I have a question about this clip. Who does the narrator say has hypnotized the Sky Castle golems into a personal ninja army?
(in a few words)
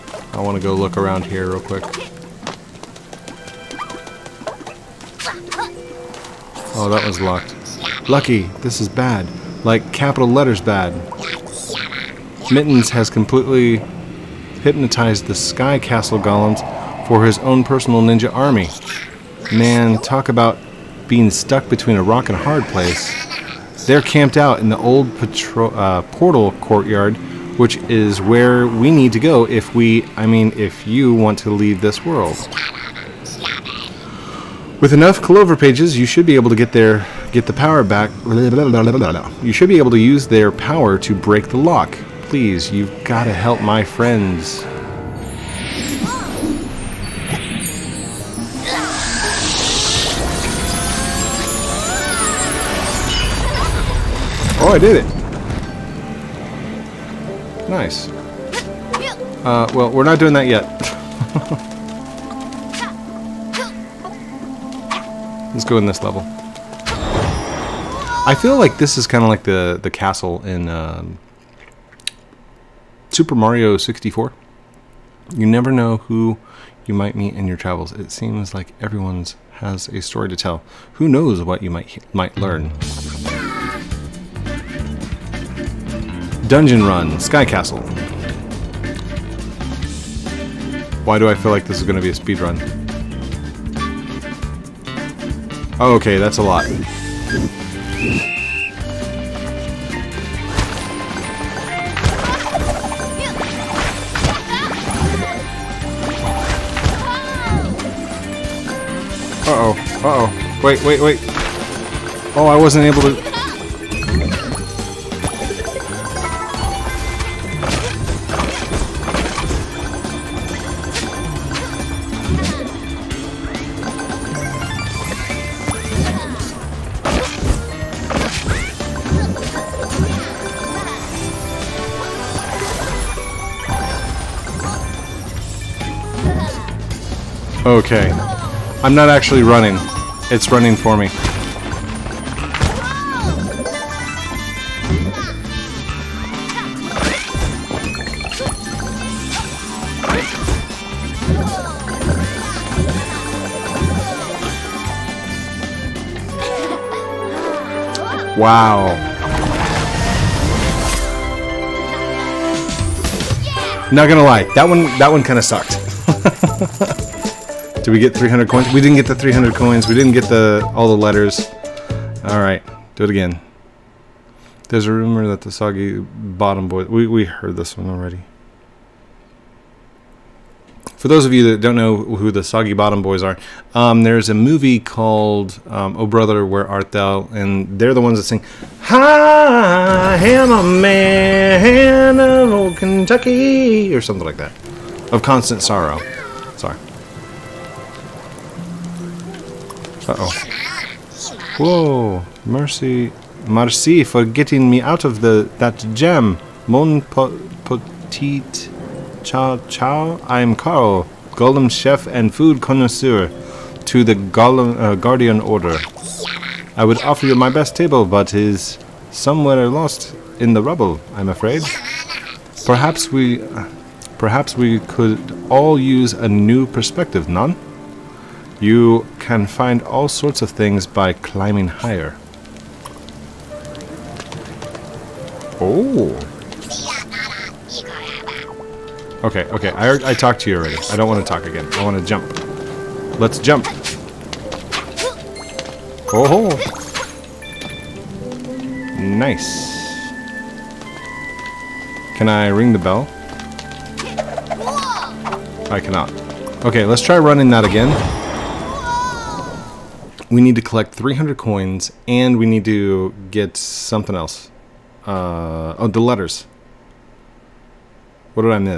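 Mittens.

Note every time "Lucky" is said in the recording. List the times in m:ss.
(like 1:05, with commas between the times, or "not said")
0:08.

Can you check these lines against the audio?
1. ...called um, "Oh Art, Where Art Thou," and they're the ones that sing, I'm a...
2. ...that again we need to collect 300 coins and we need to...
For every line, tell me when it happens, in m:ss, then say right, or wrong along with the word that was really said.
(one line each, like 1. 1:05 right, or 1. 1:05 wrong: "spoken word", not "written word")
1. 3:04 wrong: "Brother", not "Art"
2. 4:17 right.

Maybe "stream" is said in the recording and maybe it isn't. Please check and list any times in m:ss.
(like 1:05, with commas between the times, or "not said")
not said.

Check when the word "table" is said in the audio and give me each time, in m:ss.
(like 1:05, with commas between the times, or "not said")
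3:37.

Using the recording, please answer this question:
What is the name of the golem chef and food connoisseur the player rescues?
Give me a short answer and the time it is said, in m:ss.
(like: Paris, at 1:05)
Carl, at 3:30.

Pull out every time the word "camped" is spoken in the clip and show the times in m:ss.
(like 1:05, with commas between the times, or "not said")
0:24.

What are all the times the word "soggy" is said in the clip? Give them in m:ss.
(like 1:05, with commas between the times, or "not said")
2:55, 3:02.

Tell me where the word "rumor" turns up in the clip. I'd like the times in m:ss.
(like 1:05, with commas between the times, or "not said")
2:54.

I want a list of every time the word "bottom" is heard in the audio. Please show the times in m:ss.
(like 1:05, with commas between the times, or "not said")
2:55, 3:02.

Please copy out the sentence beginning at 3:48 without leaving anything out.
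You can find all sorts of things by climbing higher.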